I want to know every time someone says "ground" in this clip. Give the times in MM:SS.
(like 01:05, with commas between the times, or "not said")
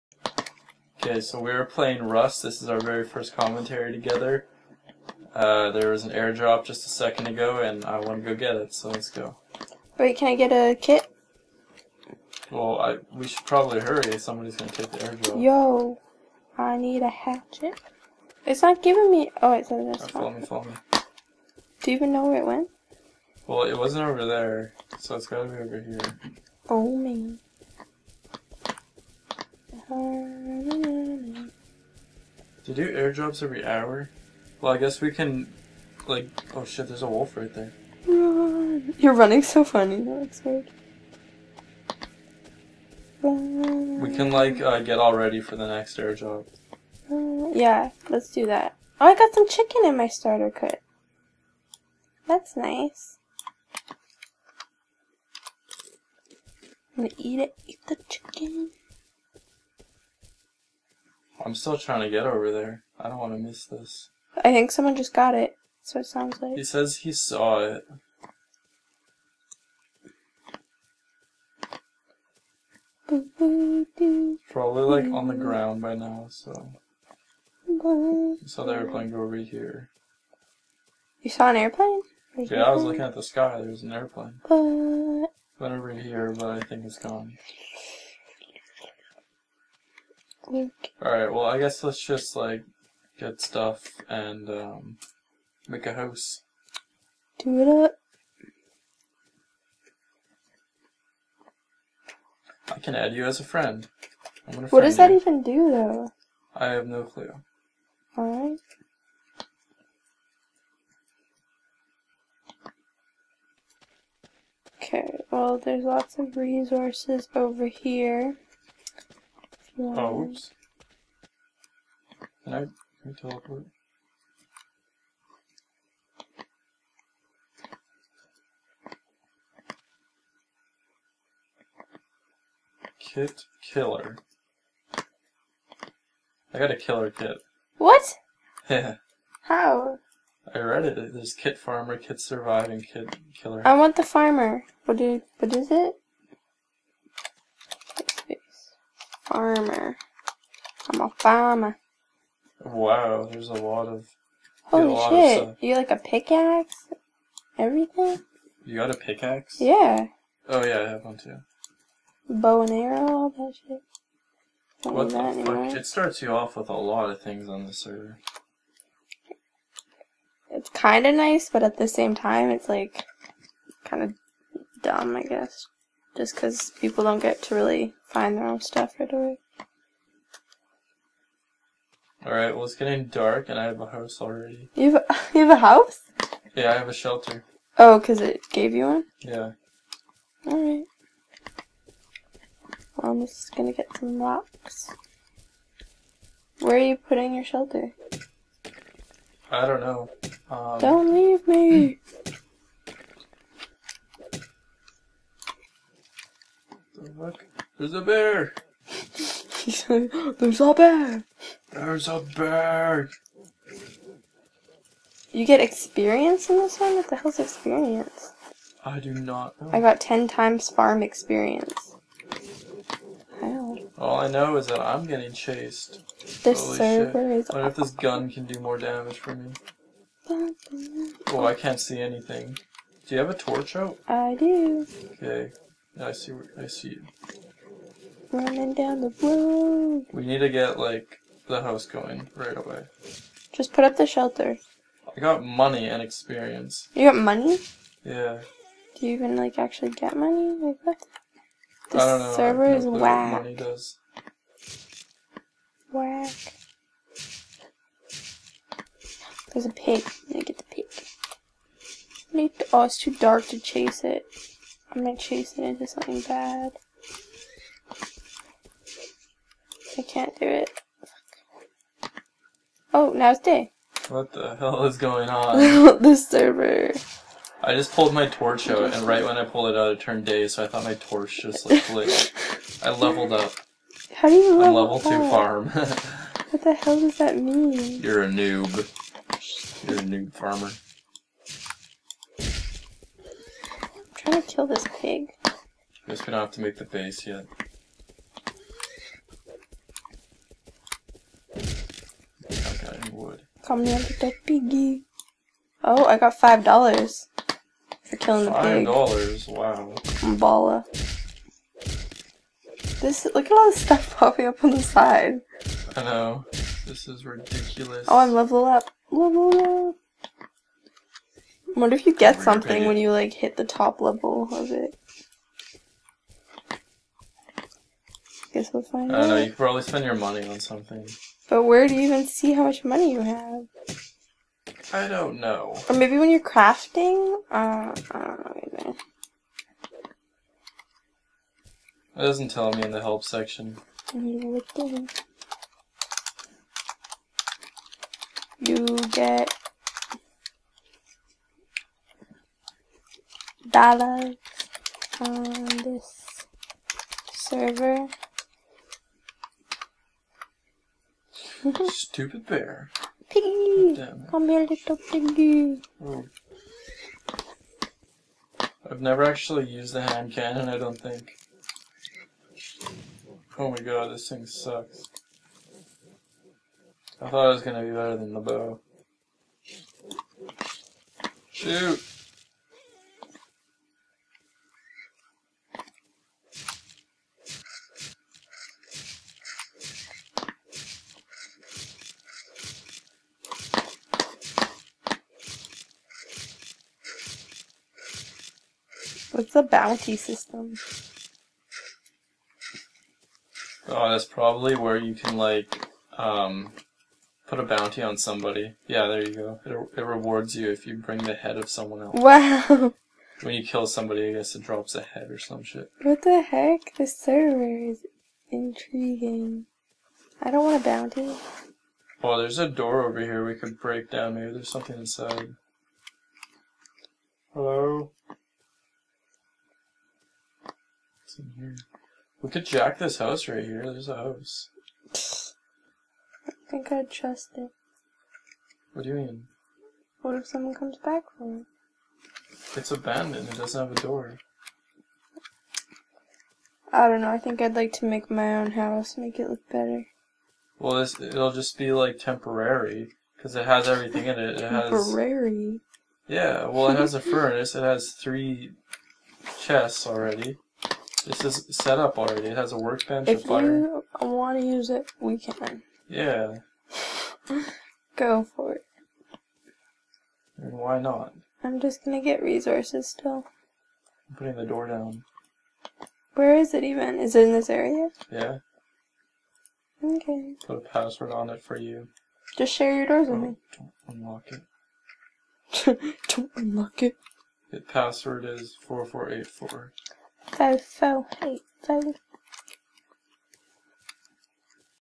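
01:15.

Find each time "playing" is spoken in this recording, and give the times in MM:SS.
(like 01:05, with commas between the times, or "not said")
00:01, 01:18.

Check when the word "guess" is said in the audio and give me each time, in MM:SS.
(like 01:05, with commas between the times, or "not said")
00:34, 01:31, 02:55, 04:56, 05:28, 06:54.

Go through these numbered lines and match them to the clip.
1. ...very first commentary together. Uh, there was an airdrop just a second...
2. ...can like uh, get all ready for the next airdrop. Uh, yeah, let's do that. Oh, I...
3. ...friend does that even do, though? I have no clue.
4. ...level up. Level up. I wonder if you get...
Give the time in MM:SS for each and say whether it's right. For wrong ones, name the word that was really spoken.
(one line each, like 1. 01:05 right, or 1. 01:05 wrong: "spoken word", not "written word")
1. 00:02 right
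2. 00:44 right
3. 01:44 right
4. 05:18 right.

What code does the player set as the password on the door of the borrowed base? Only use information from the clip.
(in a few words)
4484.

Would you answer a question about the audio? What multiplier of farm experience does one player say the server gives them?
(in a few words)
10 times.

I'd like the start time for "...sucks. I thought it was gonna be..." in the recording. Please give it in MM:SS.
06:14.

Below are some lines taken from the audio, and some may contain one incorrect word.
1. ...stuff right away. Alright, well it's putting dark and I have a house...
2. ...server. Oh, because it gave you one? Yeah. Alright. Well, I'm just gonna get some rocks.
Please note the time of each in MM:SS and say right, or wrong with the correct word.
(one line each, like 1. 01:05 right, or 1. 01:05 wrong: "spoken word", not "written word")
1. 02:58 wrong: "getting", not "putting"
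2. 03:06 wrong: "shelter", not "server".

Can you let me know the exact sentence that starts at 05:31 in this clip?
But where do you even see how much money you have?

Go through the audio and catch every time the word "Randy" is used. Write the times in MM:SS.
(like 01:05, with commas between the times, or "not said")
not said.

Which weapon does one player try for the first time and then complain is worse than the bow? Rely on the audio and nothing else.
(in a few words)
Hand cannon.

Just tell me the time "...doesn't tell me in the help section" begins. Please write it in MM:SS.
05:42.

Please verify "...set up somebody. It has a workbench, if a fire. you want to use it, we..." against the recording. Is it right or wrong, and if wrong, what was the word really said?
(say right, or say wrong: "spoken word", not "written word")
wrong: "already", not "somebody".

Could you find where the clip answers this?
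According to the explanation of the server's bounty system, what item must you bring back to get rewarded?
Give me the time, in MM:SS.
06:51.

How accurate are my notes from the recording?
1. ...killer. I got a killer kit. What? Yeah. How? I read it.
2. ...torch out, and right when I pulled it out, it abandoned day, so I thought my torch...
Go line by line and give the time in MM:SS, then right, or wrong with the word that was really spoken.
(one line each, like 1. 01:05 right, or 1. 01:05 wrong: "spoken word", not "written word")
1. 02:13 right
2. 04:38 wrong: "turned", not "abandoned".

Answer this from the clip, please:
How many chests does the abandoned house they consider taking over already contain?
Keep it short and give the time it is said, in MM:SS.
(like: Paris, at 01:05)
3, at 07:38.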